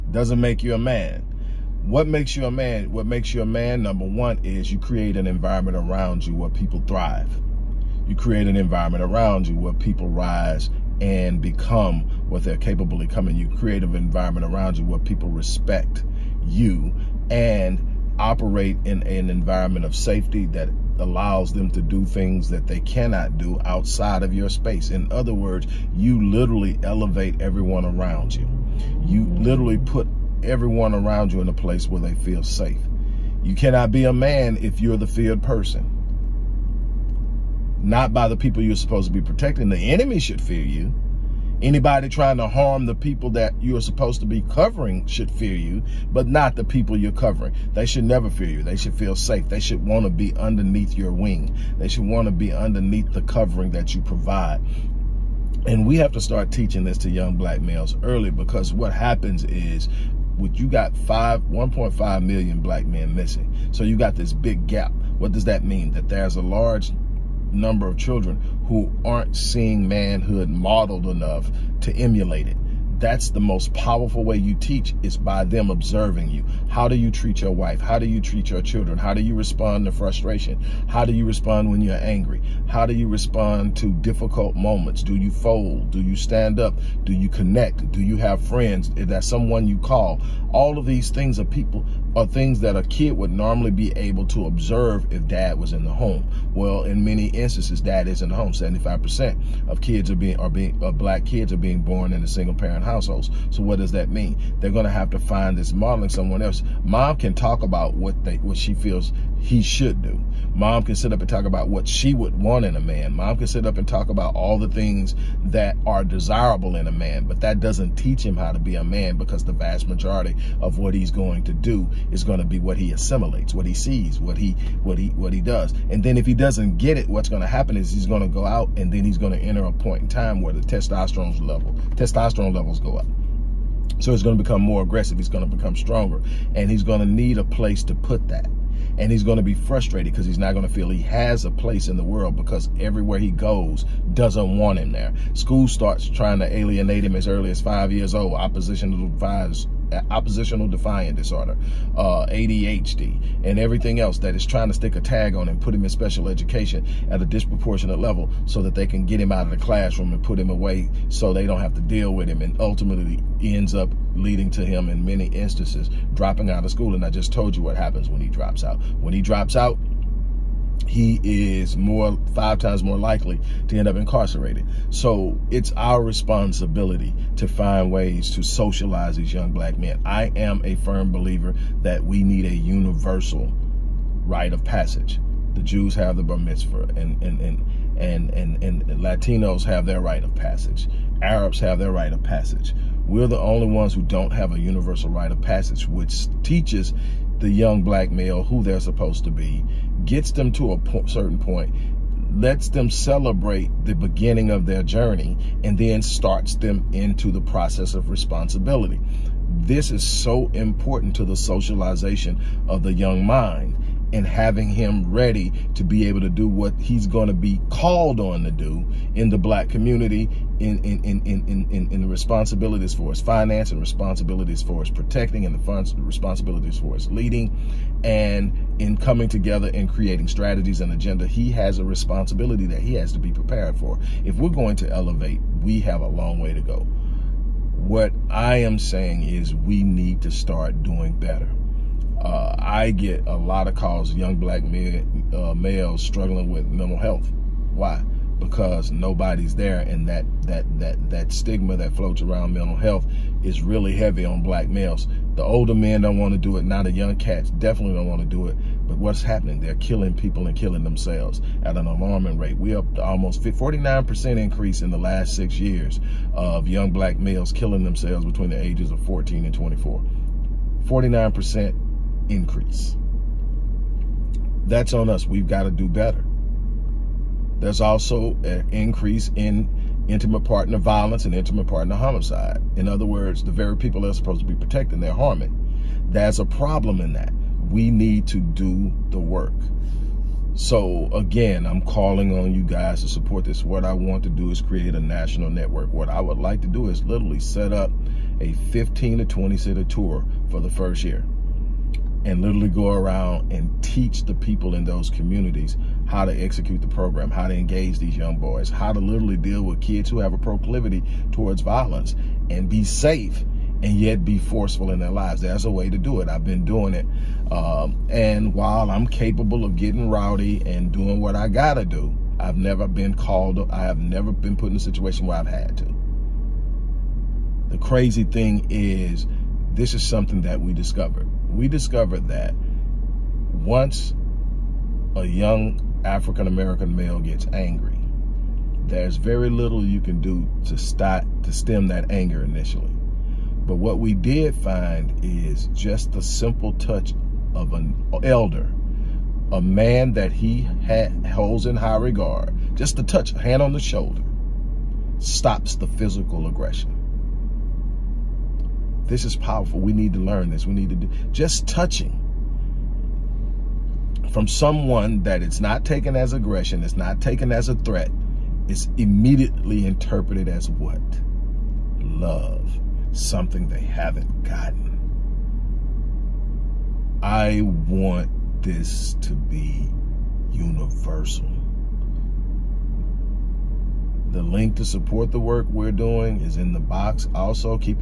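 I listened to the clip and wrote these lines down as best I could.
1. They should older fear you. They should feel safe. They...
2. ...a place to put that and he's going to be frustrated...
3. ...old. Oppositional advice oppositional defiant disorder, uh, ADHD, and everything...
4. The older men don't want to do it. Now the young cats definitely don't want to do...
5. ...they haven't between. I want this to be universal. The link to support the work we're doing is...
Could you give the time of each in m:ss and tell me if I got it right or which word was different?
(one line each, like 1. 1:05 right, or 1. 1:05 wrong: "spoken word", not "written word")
1. 0:47 wrong: "never", not "older"
2. 2:17 right
3. 2:28 right
4. 4:15 right
5. 6:13 wrong: "gotten", not "between".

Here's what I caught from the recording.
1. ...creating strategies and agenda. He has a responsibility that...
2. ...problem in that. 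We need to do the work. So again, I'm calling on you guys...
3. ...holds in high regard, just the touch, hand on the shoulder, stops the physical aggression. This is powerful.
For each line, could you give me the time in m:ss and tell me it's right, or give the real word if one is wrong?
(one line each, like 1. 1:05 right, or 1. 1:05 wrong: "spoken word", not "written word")
1. 3:49 right
2. 4:46 right
3. 5:51 right.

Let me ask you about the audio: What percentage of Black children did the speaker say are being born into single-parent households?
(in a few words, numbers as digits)
75%.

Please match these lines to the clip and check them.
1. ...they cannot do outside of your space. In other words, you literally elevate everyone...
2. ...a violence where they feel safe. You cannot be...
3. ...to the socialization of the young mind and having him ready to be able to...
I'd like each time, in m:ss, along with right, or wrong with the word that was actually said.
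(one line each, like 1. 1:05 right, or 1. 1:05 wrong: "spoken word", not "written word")
1. 0:22 right
2. 0:31 wrong: "place", not "violence"
3. 3:31 right.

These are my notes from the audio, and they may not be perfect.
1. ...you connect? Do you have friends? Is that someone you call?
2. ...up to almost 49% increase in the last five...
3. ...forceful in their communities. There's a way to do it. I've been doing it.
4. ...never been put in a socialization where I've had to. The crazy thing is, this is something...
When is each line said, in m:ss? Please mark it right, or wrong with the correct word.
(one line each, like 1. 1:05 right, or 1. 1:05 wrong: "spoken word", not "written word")
1. 1:27 right
2. 4:22 wrong: "six", not "five"
3. 5:14 wrong: "lives", not "communities"
4. 5:23 wrong: "situation", not "socialization".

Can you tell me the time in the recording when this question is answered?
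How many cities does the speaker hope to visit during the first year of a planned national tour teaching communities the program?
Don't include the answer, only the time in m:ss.
4:58.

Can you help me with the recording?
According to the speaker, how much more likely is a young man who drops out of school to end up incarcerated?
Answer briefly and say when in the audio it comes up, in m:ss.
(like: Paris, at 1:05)
5 times, at 2:52.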